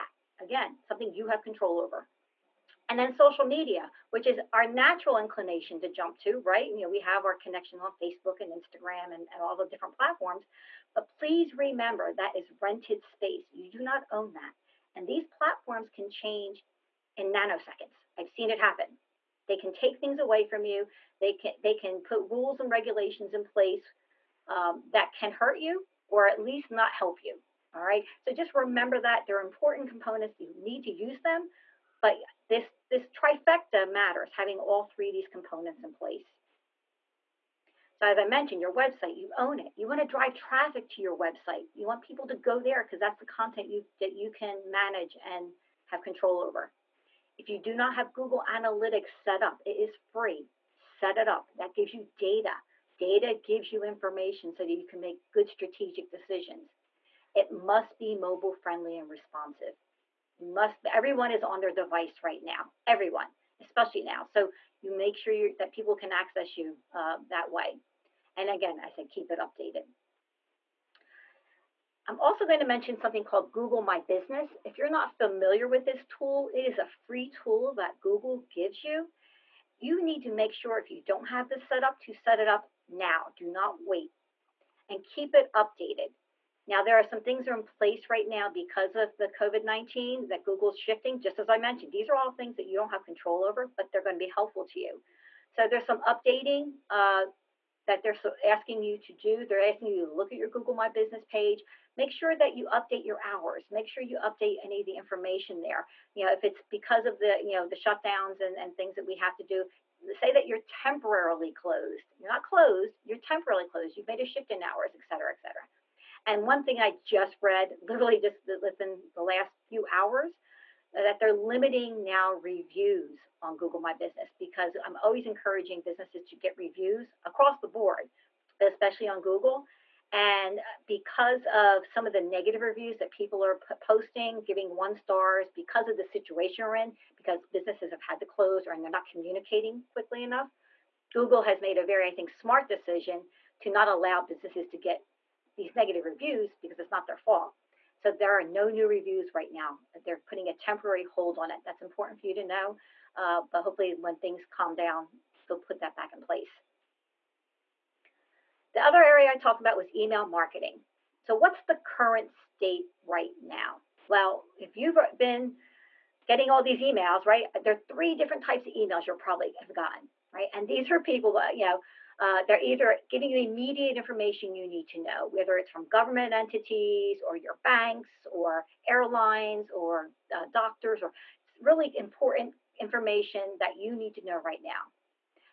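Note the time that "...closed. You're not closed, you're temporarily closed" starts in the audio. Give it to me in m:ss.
1:51.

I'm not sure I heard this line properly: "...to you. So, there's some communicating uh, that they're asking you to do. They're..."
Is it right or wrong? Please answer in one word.
wrong.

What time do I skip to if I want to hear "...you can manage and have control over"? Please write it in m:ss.
0:44.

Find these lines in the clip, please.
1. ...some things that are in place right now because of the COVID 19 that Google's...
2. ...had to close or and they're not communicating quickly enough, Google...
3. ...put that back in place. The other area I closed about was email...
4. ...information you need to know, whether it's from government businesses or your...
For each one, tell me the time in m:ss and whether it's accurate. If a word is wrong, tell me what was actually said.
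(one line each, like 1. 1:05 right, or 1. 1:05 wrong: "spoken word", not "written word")
1. 1:27 right
2. 2:18 right
3. 2:35 wrong: "talked", not "closed"
4. 2:53 wrong: "entities", not "businesses".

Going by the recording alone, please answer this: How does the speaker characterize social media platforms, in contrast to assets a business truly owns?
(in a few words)
Rented space.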